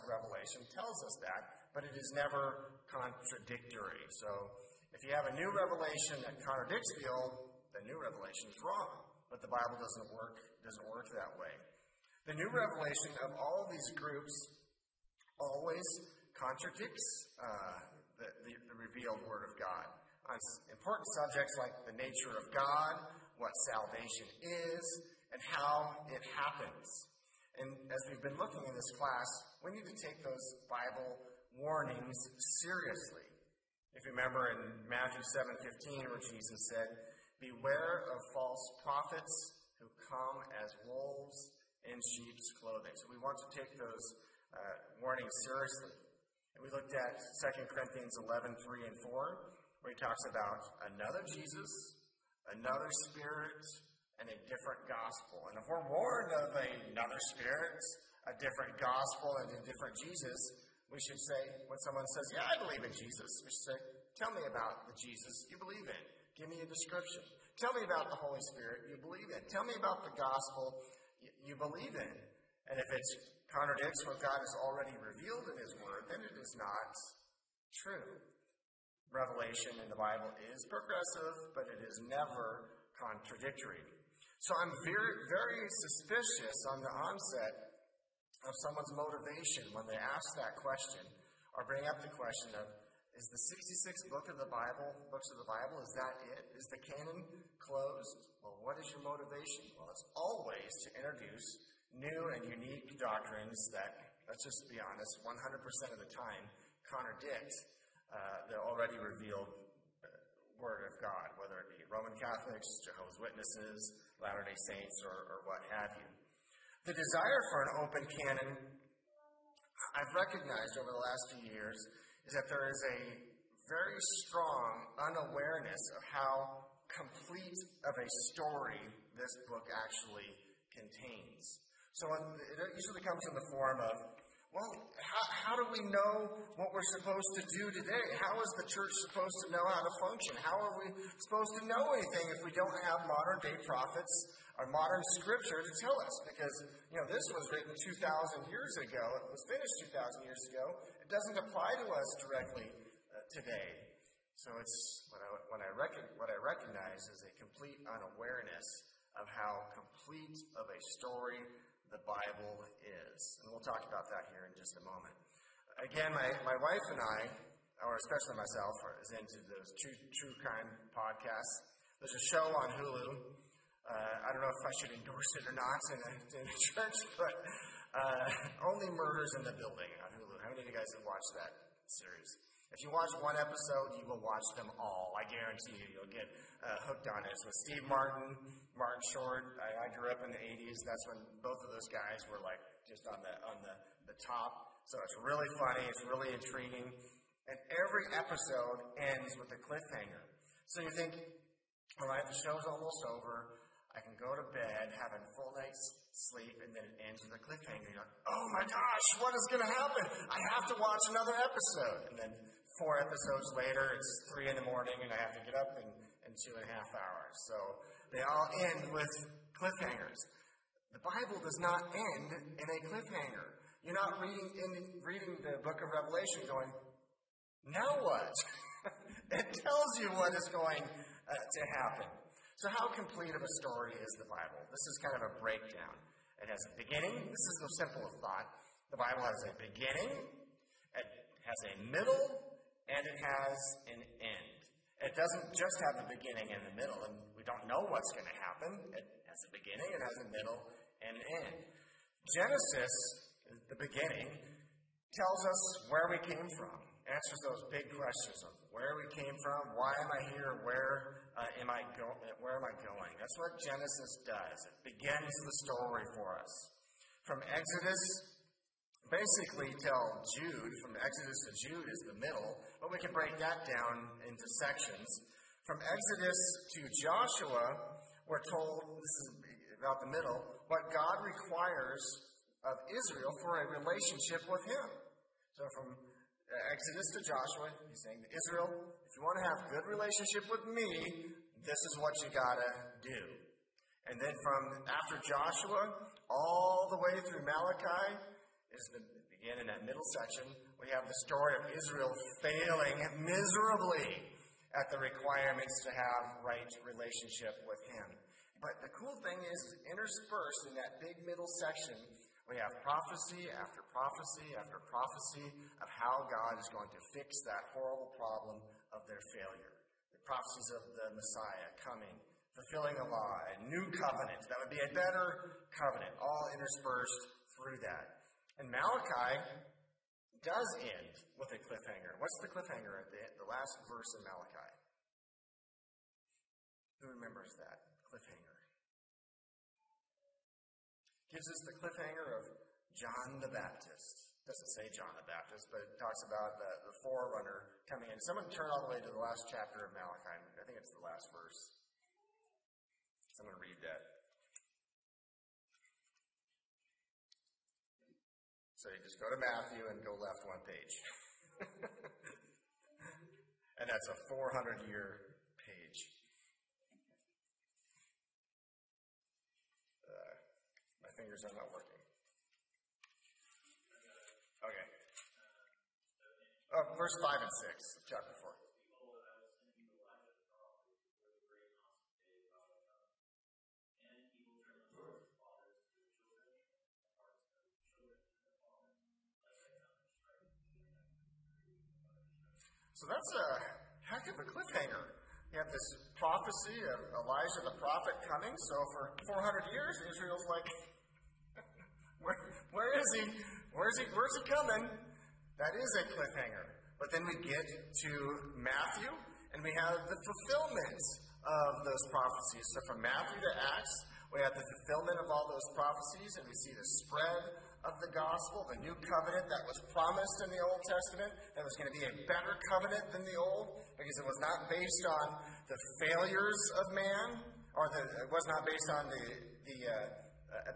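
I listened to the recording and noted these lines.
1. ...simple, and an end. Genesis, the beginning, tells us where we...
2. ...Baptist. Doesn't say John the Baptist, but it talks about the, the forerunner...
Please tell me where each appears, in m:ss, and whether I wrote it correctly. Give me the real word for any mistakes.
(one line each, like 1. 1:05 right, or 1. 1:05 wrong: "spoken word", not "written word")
1. 4:10 wrong: "middle", not "simple"
2. 5:43 right.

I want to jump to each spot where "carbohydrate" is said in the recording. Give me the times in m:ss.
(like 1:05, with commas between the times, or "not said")
not said.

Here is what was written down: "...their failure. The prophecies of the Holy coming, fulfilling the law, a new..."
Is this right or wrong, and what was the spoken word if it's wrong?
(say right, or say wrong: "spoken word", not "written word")
wrong: "Messiah", not "Holy".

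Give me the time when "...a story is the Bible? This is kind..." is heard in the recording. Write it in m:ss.
3:53.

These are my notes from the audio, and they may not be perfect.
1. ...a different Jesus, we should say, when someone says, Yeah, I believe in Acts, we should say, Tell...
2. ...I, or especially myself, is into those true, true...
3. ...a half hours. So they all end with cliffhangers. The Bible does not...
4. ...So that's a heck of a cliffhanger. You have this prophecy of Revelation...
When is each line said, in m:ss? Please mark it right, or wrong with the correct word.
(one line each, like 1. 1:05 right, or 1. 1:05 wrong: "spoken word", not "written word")
1. 0:59 wrong: "Jesus", not "Acts"
2. 2:47 right
3. 3:36 right
4. 6:32 wrong: "Elijah", not "Revelation".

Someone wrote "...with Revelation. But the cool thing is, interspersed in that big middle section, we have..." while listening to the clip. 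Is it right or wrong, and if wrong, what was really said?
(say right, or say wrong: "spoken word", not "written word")
wrong: "Him", not "Revelation".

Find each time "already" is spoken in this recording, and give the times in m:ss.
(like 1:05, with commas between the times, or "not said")
1:14, 1:48.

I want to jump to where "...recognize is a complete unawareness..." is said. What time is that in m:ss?
2:36.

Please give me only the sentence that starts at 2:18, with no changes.
How is the church supposed to know how to function?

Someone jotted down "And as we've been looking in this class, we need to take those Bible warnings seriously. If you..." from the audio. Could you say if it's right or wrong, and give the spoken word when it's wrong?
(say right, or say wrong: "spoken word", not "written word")
right.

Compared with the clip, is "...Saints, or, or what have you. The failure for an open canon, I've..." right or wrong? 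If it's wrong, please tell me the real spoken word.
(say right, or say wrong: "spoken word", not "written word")
wrong: "desire", not "failure".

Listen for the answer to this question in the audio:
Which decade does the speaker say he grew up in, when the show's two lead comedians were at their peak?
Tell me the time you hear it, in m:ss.
3:10.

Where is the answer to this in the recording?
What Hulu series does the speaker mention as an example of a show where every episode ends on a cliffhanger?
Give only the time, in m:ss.
2:58.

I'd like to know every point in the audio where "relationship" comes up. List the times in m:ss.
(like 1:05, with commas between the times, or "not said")
4:43, 4:49, 5:06.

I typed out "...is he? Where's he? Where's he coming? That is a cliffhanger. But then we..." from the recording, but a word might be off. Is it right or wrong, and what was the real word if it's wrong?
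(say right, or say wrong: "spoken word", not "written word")
right.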